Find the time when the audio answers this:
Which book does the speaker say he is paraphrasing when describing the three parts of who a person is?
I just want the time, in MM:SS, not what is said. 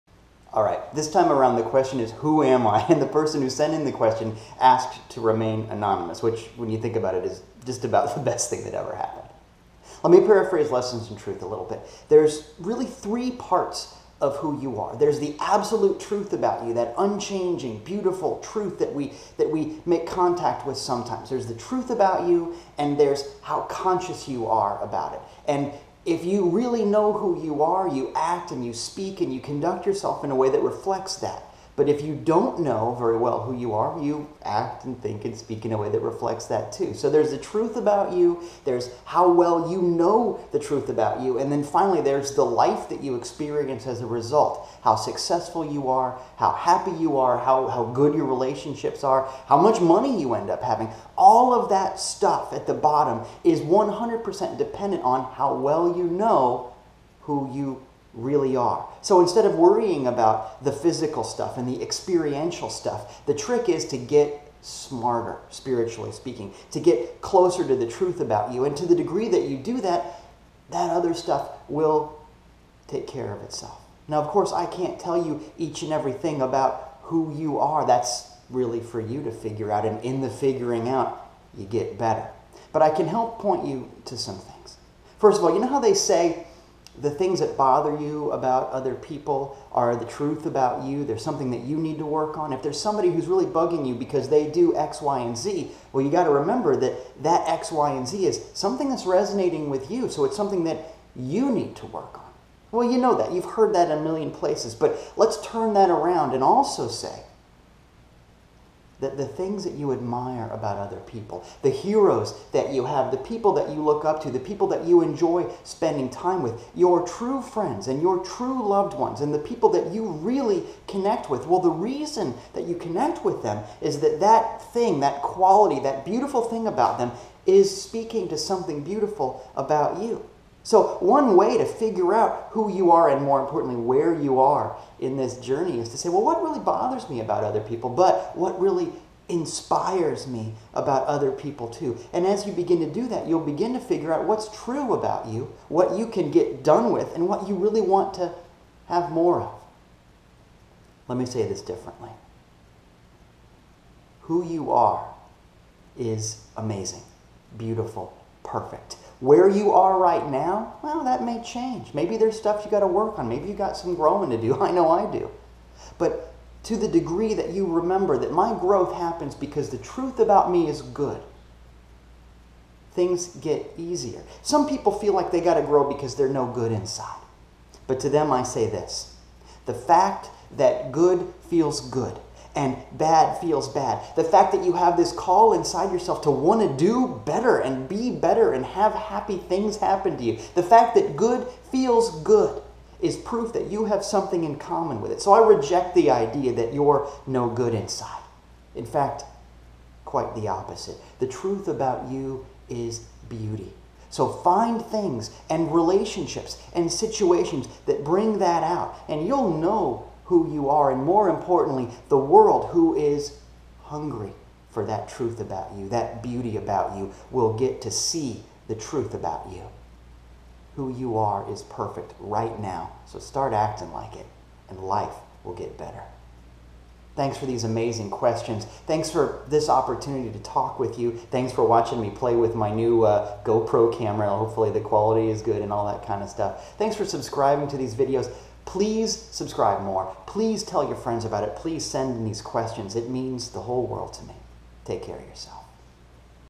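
00:10.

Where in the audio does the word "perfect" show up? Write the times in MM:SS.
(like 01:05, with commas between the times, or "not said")
02:38, 03:41.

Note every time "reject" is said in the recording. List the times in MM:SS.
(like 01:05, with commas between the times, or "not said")
03:15.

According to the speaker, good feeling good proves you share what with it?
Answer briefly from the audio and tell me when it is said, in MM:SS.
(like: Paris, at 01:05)
something in common, at 03:14.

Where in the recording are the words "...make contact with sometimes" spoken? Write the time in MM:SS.
00:19.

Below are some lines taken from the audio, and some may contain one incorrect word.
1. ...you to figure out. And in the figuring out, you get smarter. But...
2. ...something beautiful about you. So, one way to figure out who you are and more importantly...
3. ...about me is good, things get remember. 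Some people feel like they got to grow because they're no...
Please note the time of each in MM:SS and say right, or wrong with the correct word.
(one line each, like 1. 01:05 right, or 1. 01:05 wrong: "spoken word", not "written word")
1. 01:18 wrong: "better", not "smarter"
2. 02:08 right
3. 02:50 wrong: "easier", not "remember".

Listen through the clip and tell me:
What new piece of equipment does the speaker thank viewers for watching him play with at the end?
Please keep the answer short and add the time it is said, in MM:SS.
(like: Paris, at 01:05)
GoPro camera, at 03:53.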